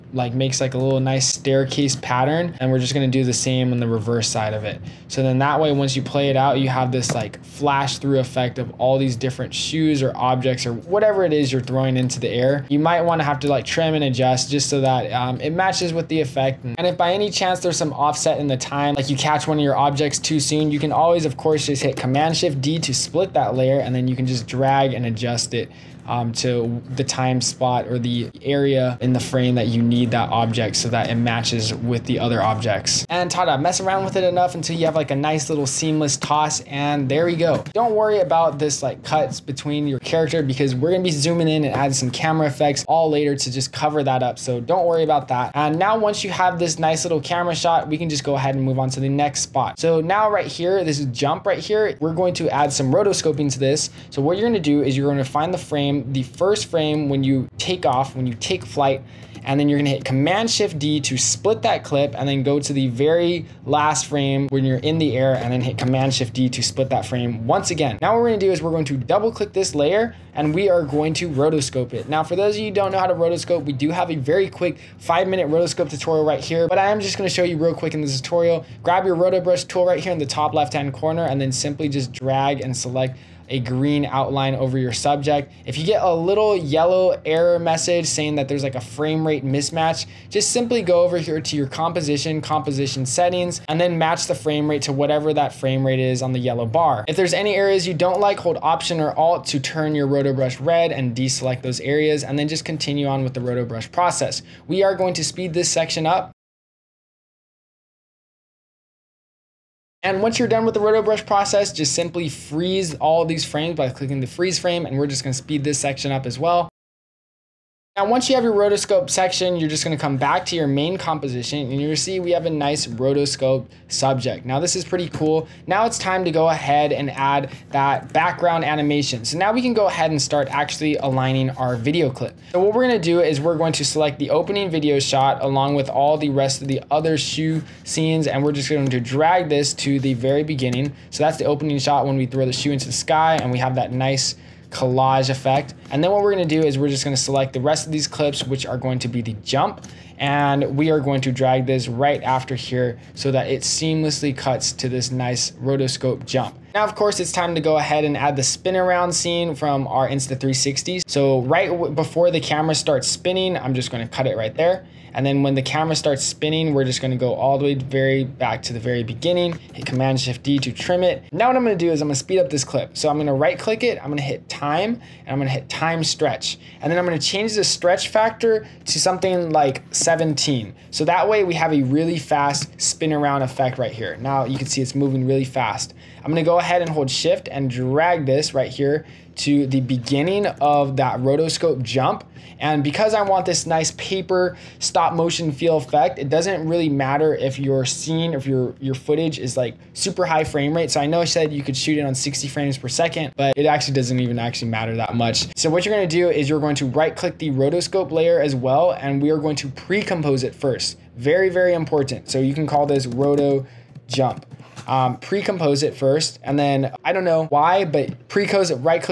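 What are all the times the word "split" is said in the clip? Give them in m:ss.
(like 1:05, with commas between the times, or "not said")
0:22, 1:01, 1:06.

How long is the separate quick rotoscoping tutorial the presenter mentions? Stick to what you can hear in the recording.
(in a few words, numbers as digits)
5 minutes.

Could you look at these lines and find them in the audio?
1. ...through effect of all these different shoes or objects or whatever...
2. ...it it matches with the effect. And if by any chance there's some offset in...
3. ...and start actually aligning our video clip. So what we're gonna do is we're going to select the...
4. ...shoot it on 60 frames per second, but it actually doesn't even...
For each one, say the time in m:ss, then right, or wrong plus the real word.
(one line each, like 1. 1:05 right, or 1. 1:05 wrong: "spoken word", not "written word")
1. 0:07 right
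2. 0:15 right
3. 2:10 right
4. 3:21 right.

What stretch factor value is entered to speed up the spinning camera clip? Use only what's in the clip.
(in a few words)
17.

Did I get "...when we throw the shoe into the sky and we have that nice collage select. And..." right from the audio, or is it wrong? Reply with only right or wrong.
wrong.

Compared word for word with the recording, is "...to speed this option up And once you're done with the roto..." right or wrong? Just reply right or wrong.
wrong.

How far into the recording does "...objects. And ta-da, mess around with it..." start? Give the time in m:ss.
0:32.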